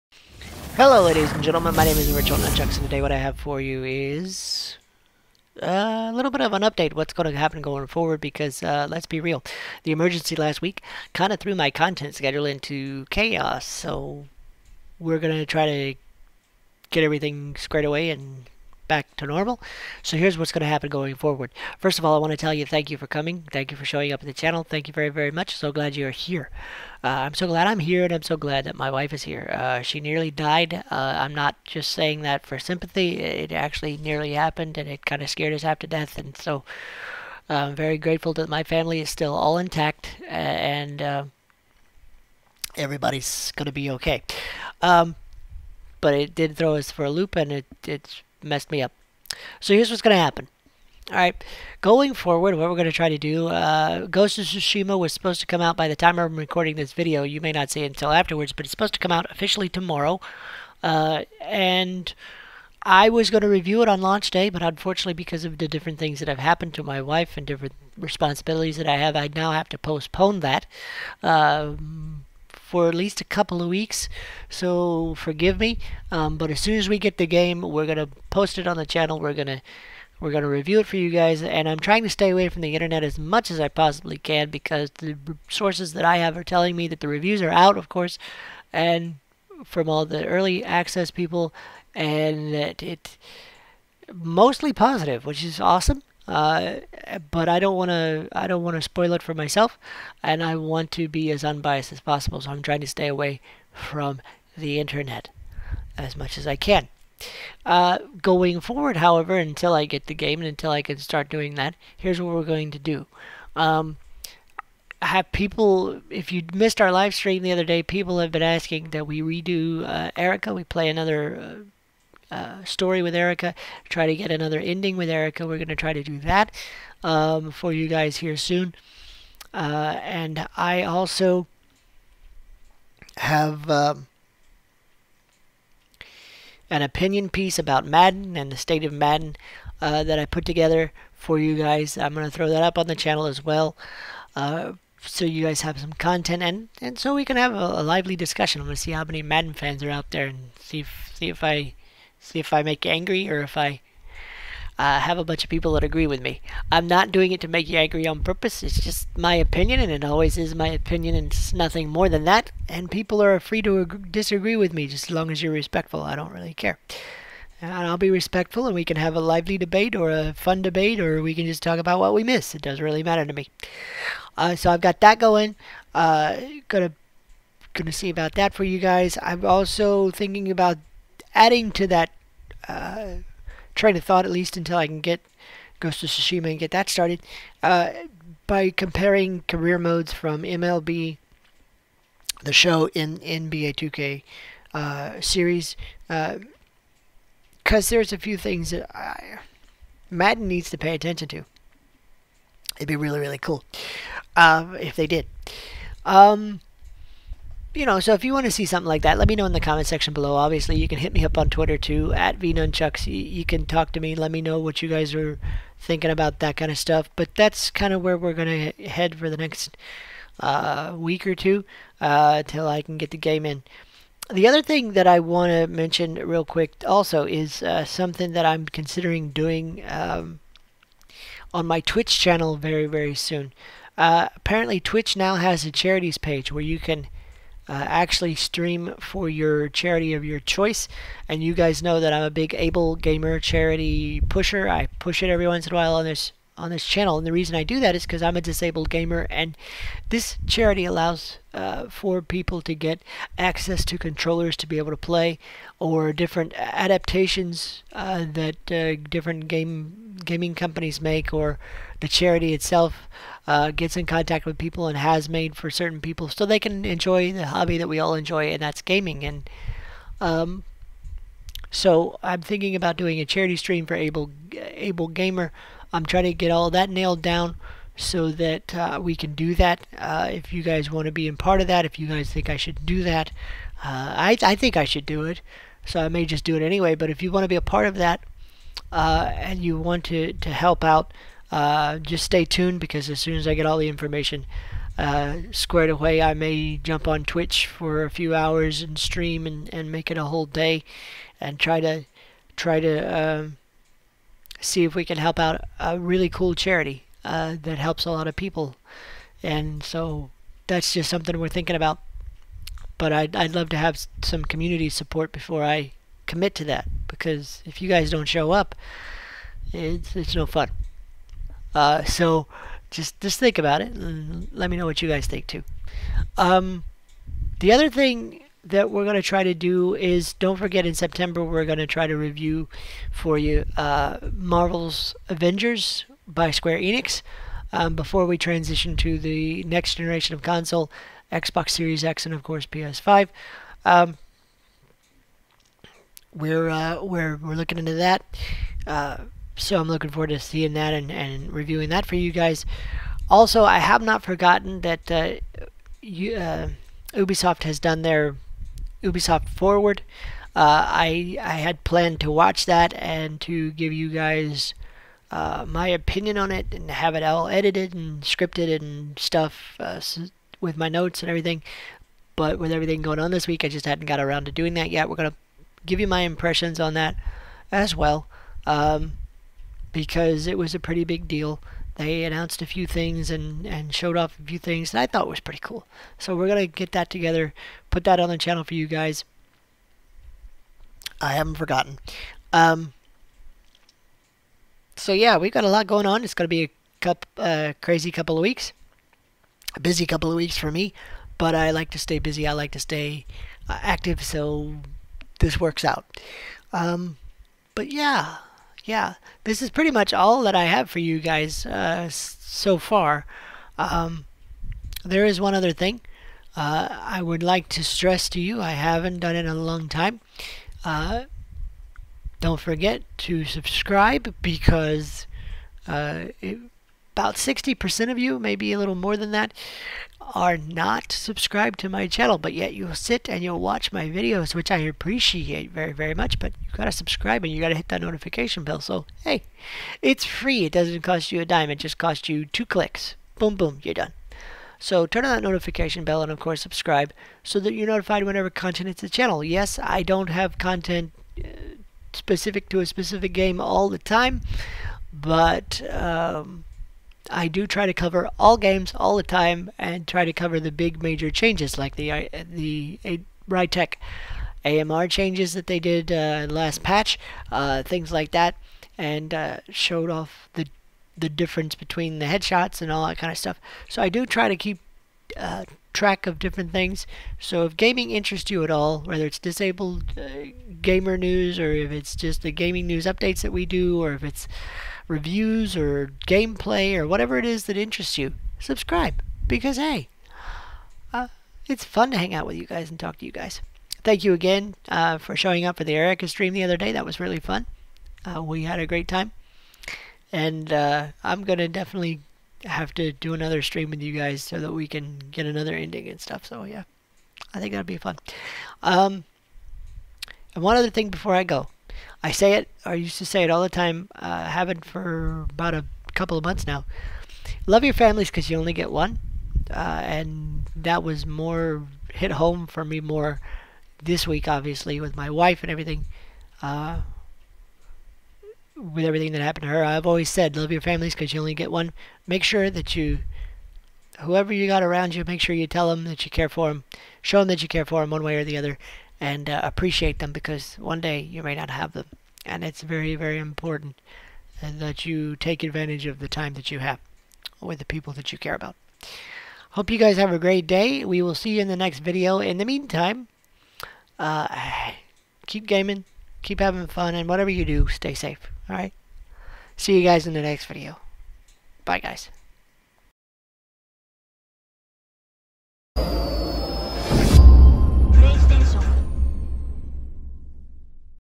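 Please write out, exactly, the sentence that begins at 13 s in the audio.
So we're gonna try to get everything squared away and back to normal.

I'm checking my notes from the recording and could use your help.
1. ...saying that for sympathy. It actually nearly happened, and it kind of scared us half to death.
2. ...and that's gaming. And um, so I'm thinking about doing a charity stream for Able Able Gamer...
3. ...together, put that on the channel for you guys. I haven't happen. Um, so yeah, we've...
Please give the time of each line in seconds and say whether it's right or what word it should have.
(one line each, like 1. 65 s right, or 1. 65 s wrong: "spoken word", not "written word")
1. 31 s right
2. 268 s right
3. 387 s wrong: "forgotten", not "happen".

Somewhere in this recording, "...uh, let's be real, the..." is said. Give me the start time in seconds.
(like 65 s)
8 s.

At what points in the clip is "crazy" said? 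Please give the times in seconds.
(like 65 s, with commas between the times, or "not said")
397 s.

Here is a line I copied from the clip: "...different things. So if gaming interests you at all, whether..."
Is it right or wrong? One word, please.
right.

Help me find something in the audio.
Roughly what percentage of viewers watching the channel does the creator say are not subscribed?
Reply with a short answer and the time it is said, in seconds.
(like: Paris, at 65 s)
60%, at 427 s.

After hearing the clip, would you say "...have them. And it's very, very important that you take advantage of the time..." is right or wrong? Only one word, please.
right.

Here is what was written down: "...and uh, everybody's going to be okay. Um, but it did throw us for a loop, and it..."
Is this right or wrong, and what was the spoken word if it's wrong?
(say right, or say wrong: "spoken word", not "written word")
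right.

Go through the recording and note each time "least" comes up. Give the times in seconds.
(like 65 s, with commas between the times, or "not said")
72 s, 184 s.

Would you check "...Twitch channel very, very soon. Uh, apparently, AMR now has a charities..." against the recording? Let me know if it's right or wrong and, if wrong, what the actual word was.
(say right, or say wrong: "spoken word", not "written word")
wrong: "Twitch", not "AMR".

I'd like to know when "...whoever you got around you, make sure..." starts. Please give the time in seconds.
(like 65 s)
534 s.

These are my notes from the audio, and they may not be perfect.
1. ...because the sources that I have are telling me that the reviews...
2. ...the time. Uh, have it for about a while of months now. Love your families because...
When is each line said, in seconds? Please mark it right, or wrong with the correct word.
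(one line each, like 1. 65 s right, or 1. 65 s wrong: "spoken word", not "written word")
1. 84 s right
2. 513 s wrong: "couple", not "while".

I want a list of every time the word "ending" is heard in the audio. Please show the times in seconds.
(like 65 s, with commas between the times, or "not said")
124 s, 505 s.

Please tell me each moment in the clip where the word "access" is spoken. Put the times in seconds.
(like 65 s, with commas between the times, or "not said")
90 s, 253 s.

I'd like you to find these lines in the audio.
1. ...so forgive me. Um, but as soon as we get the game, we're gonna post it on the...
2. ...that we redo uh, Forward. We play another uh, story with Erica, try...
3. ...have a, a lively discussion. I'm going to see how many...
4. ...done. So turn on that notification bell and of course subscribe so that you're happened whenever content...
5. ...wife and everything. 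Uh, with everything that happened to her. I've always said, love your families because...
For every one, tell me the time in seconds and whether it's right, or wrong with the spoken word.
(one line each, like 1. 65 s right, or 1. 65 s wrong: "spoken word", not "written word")
1. 74 s right
2. 118 s wrong: "Erica", not "Forward"
3. 147 s right
4. 443 s wrong: "notified", not "happened"
5. 525 s right.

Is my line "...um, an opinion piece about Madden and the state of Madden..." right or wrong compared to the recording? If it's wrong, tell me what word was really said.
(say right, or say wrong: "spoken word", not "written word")
right.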